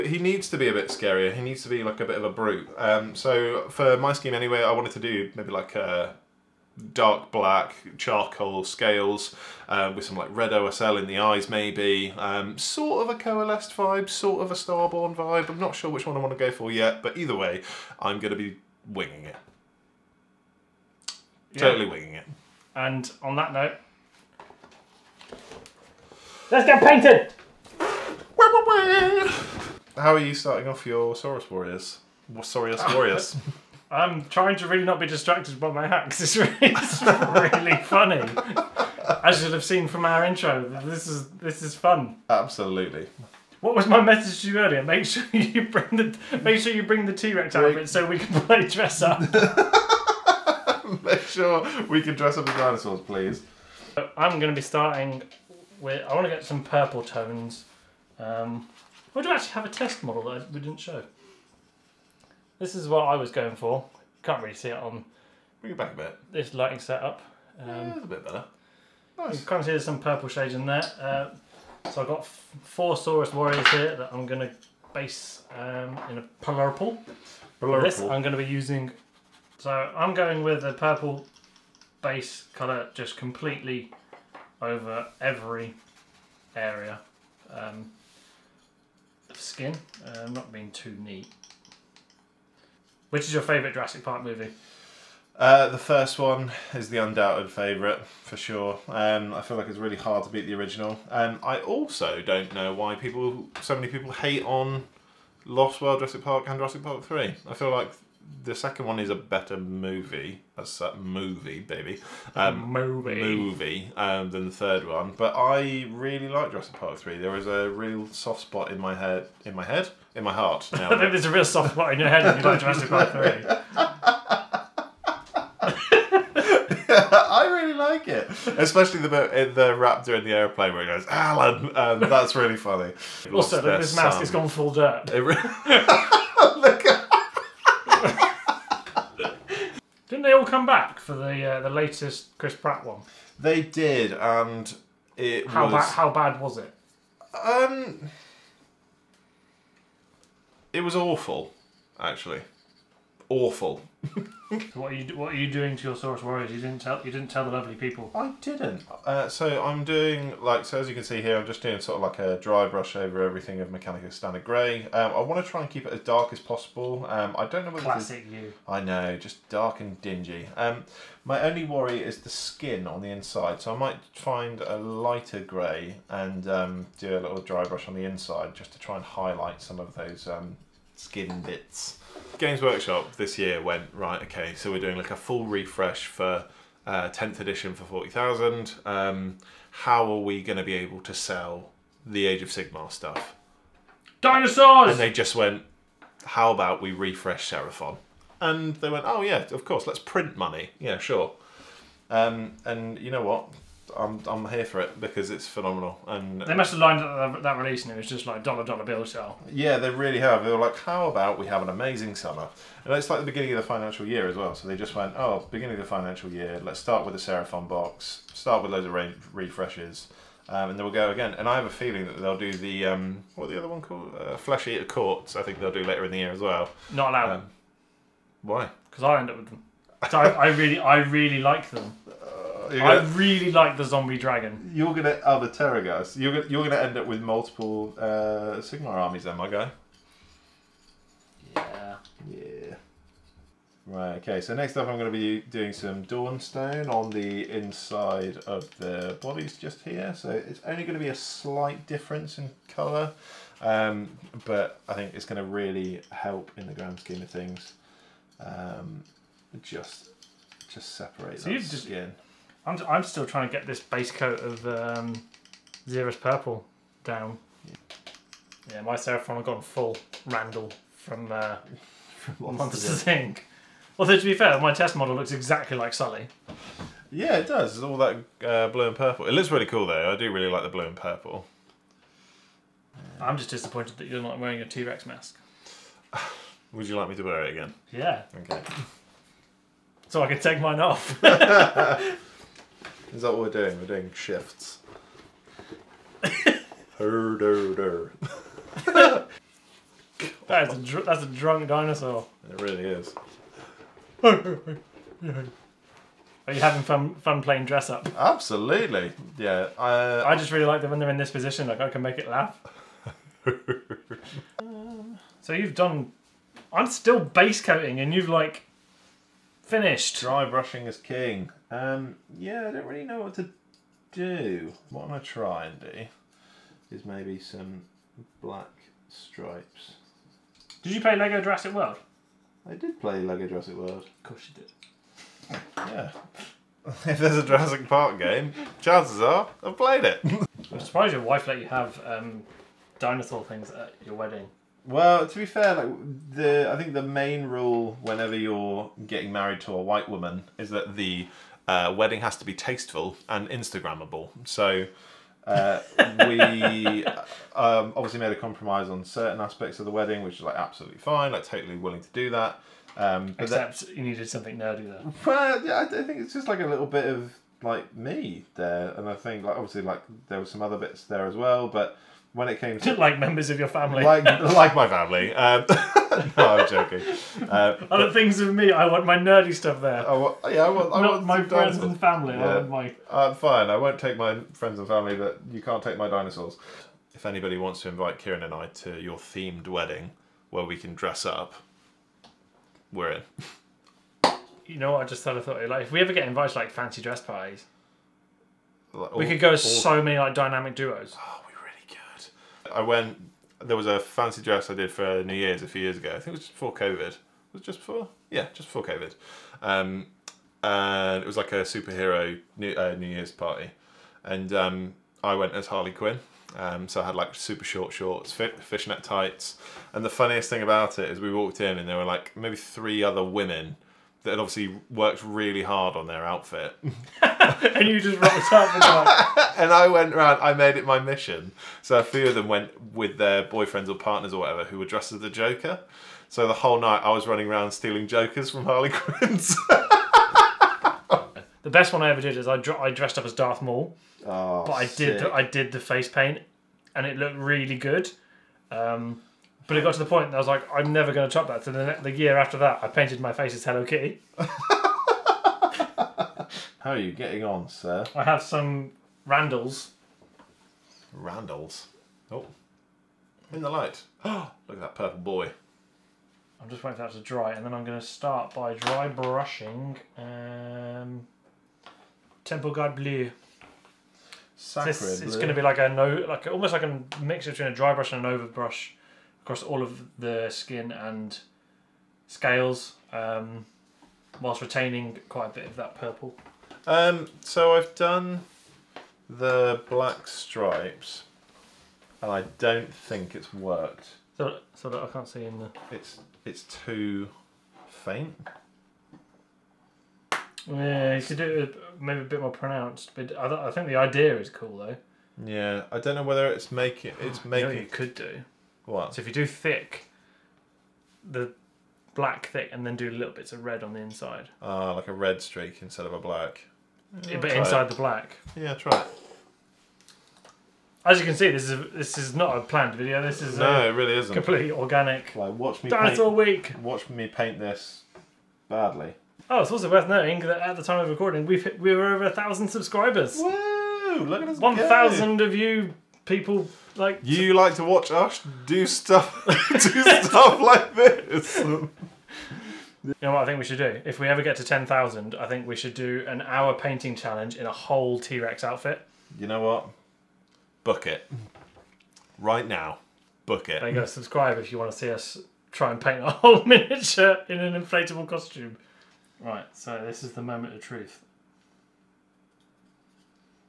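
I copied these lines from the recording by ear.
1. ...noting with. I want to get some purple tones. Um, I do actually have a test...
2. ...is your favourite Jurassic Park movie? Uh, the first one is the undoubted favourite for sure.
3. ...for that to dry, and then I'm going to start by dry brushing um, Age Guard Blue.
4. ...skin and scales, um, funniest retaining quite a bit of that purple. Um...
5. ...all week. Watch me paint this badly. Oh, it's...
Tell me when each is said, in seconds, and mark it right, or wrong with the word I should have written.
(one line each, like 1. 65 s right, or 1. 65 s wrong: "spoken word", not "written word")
1. 54 s wrong: "starting", not "noting"
2. 93 s right
3. 466 s wrong: "Temple", not "Age"
4. 480 s wrong: "whilst", not "funniest"
5. 526 s right.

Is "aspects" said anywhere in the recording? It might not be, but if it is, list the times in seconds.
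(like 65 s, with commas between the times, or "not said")
359 s.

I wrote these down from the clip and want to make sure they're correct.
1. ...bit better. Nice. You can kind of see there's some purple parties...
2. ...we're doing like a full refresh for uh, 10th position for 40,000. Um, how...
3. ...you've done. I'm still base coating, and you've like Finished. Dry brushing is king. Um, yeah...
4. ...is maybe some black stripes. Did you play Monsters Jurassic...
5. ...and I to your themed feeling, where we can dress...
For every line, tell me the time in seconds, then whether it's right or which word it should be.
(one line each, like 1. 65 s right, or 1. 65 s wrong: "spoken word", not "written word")
1. 68 s wrong: "shades", not "parties"
2. 184 s wrong: "edition", not "position"
3. 315 s right
4. 326 s wrong: "Lego", not "Monsters"
5. 388 s wrong: "wedding", not "feeling".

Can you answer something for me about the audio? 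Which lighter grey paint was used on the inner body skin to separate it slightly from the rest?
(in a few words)
Dawnstone.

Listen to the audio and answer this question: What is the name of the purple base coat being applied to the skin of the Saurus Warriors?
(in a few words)
Xereus Purple.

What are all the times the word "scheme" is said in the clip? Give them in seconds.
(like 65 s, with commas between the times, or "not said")
4 s, 257 s.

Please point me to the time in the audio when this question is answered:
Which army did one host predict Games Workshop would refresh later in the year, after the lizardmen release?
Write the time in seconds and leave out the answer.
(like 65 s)
224 s.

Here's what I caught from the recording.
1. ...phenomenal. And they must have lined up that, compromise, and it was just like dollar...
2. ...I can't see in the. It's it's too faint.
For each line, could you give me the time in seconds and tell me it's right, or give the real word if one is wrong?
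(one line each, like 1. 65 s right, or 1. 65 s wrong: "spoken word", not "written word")
1. 205 s wrong: "release", not "compromise"
2. 495 s right.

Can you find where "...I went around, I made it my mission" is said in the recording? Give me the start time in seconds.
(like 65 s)
429 s.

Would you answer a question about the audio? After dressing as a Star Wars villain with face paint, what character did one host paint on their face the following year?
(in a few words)
Hello Kitty.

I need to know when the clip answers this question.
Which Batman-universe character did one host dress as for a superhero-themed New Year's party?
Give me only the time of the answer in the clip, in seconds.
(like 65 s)
415 s.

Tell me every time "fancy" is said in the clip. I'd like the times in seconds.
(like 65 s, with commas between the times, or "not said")
396 s, 403 s.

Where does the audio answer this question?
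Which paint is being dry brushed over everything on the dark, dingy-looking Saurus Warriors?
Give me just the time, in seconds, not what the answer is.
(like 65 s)
163 s.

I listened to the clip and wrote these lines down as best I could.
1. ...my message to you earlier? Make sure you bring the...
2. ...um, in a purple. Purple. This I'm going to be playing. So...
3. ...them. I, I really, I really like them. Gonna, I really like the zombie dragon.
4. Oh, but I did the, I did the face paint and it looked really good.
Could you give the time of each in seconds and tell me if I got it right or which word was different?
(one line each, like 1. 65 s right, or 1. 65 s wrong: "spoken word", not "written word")
1. 43 s right
2. 75 s wrong: "using", not "playing"
3. 229 s right
4. 444 s right.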